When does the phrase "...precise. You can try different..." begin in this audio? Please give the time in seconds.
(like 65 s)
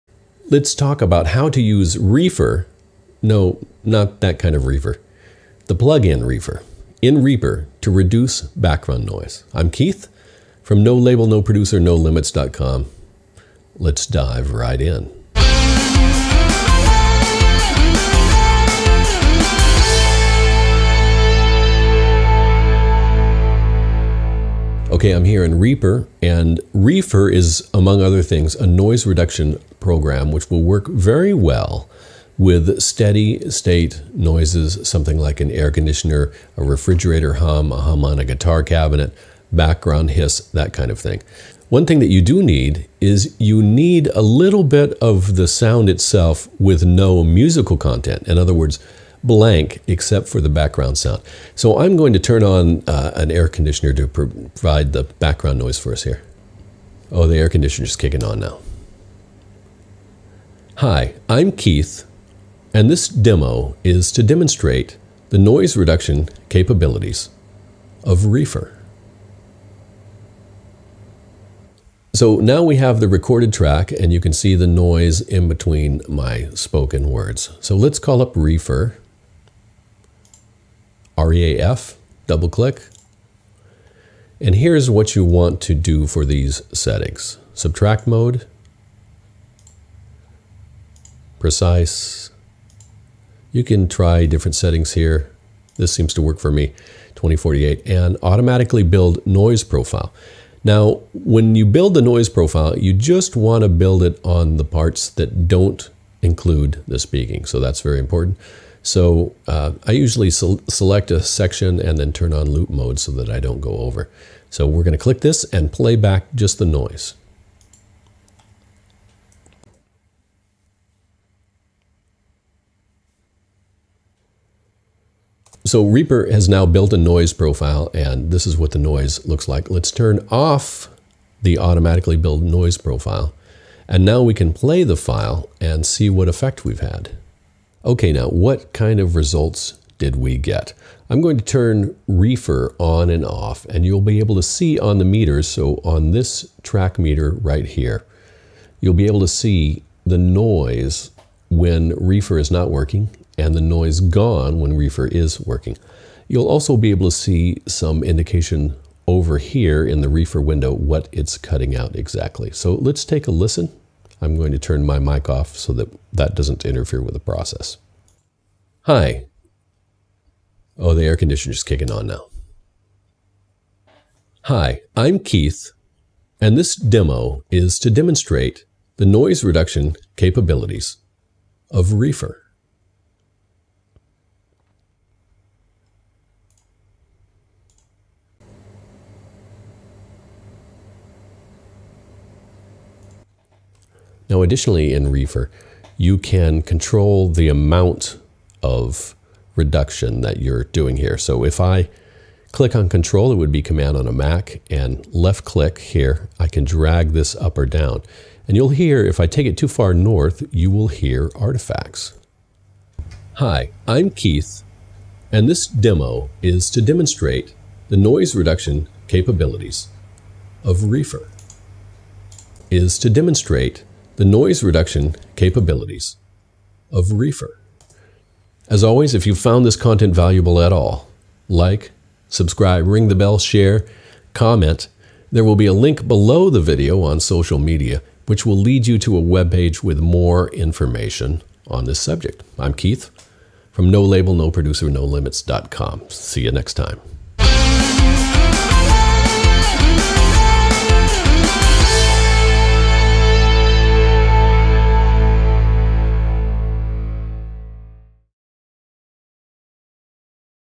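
91 s.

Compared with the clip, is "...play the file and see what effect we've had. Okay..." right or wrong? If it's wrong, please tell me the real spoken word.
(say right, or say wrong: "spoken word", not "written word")
right.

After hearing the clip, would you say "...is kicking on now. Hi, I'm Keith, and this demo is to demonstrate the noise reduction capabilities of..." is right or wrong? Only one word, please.
right.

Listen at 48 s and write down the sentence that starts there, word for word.
In other words, blank except for the background sound.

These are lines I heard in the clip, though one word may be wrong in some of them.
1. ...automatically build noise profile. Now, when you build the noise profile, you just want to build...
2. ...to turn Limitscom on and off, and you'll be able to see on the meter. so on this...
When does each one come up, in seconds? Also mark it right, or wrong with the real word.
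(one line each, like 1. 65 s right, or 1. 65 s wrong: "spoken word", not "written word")
1. 98 s right
2. 141 s wrong: "ReaFIR", not "Limitscom".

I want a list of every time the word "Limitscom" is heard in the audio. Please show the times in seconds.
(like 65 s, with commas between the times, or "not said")
11 s, 245 s.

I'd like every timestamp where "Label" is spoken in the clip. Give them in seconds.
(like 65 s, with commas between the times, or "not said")
10 s, 244 s.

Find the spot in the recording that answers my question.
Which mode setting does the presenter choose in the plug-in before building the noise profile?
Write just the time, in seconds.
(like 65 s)
87 s.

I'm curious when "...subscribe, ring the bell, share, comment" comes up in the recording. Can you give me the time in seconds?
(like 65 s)
232 s.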